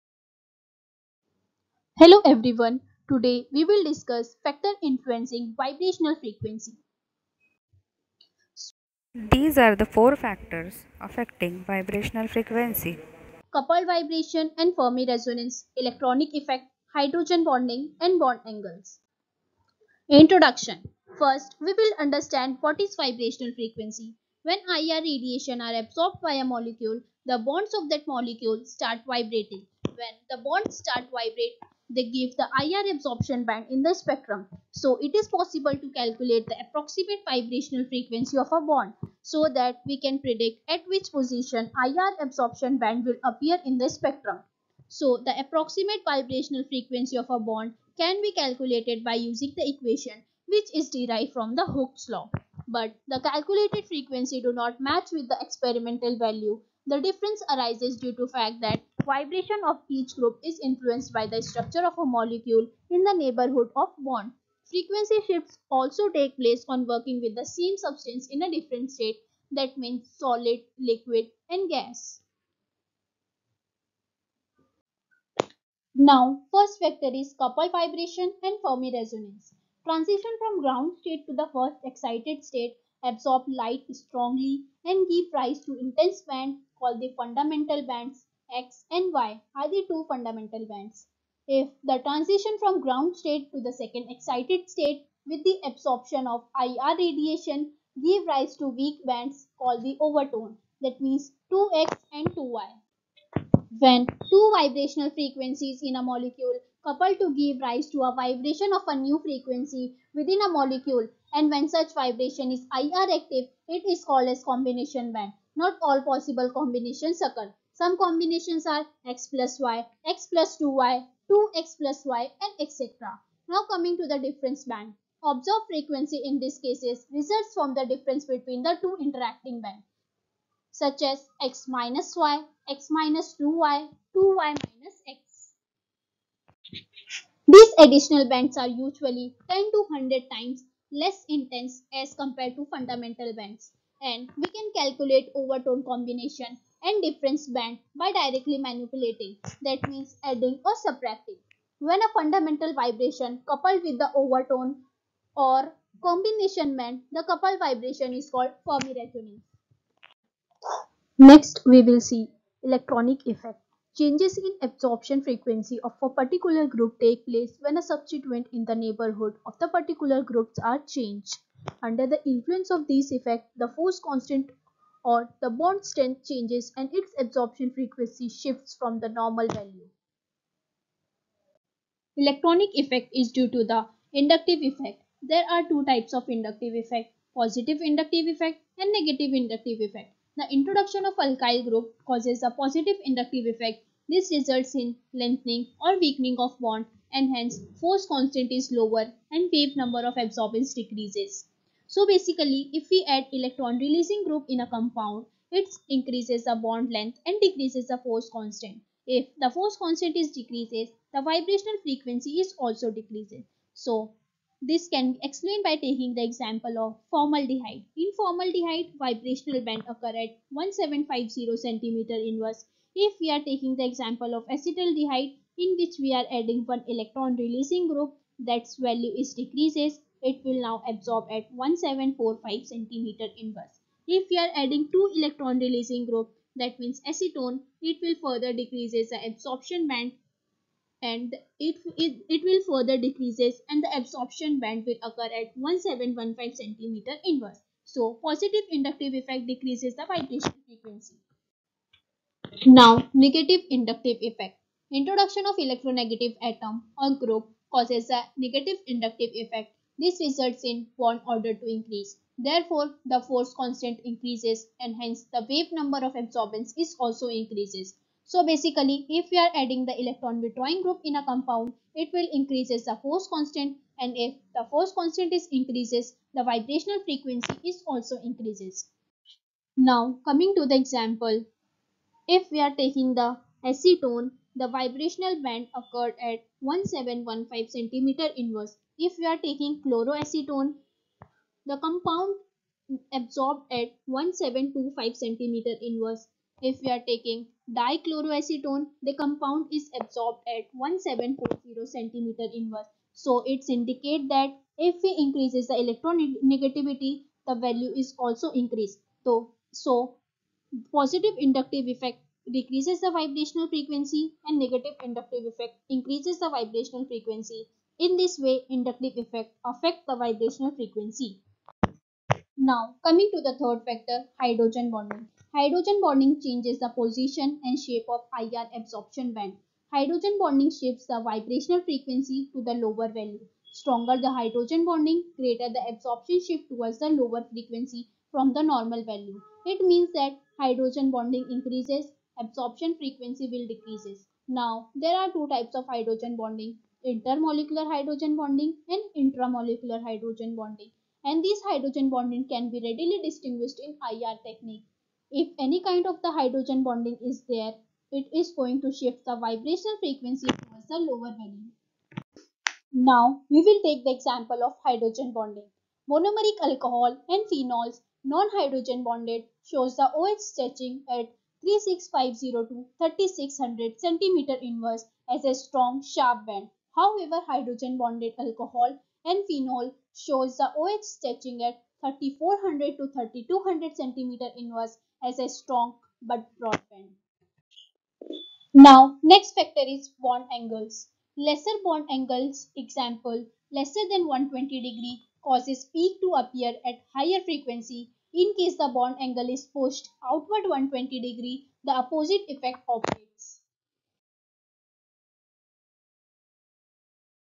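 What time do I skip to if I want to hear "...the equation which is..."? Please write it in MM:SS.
00:49.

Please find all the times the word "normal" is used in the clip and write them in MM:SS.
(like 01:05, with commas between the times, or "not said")
02:59, 05:38.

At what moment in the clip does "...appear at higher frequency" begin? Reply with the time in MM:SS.
06:36.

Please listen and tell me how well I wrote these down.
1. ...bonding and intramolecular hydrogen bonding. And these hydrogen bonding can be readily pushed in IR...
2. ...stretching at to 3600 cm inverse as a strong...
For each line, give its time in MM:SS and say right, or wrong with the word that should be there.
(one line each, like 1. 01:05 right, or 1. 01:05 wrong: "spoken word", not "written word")
1. 05:48 wrong: "distinguished", not "pushed"
2. 06:10 right.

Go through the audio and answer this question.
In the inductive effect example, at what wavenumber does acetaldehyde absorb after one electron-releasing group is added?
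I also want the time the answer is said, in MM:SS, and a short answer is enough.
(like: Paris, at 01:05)
1745 cm-1, at 03:51.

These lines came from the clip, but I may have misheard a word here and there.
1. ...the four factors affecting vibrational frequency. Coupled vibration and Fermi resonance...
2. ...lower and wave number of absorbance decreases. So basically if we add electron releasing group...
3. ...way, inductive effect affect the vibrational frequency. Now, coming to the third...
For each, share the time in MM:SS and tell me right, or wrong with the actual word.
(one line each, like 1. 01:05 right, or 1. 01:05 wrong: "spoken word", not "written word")
1. 00:09 right
2. 03:18 right
3. 05:18 right.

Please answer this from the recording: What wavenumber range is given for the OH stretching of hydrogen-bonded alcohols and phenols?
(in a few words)
3400 to 3200 cm-1.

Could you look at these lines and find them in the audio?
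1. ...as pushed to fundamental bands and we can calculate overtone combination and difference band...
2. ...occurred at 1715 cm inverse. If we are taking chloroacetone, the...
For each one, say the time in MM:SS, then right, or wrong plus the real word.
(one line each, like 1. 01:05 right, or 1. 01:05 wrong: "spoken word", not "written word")
1. 02:21 wrong: "compared", not "pushed"
2. 04:45 right.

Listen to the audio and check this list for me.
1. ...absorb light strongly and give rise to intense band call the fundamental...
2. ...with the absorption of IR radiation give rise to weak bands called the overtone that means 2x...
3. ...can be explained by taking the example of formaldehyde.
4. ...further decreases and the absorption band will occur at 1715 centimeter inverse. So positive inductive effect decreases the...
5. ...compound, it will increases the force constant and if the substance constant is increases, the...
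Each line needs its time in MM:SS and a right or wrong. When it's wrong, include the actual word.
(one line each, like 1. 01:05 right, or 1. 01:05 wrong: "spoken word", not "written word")
1. 01:23 right
2. 01:35 right
3. 03:34 right
4. 04:02 right
5. 04:31 wrong: "force", not "substance".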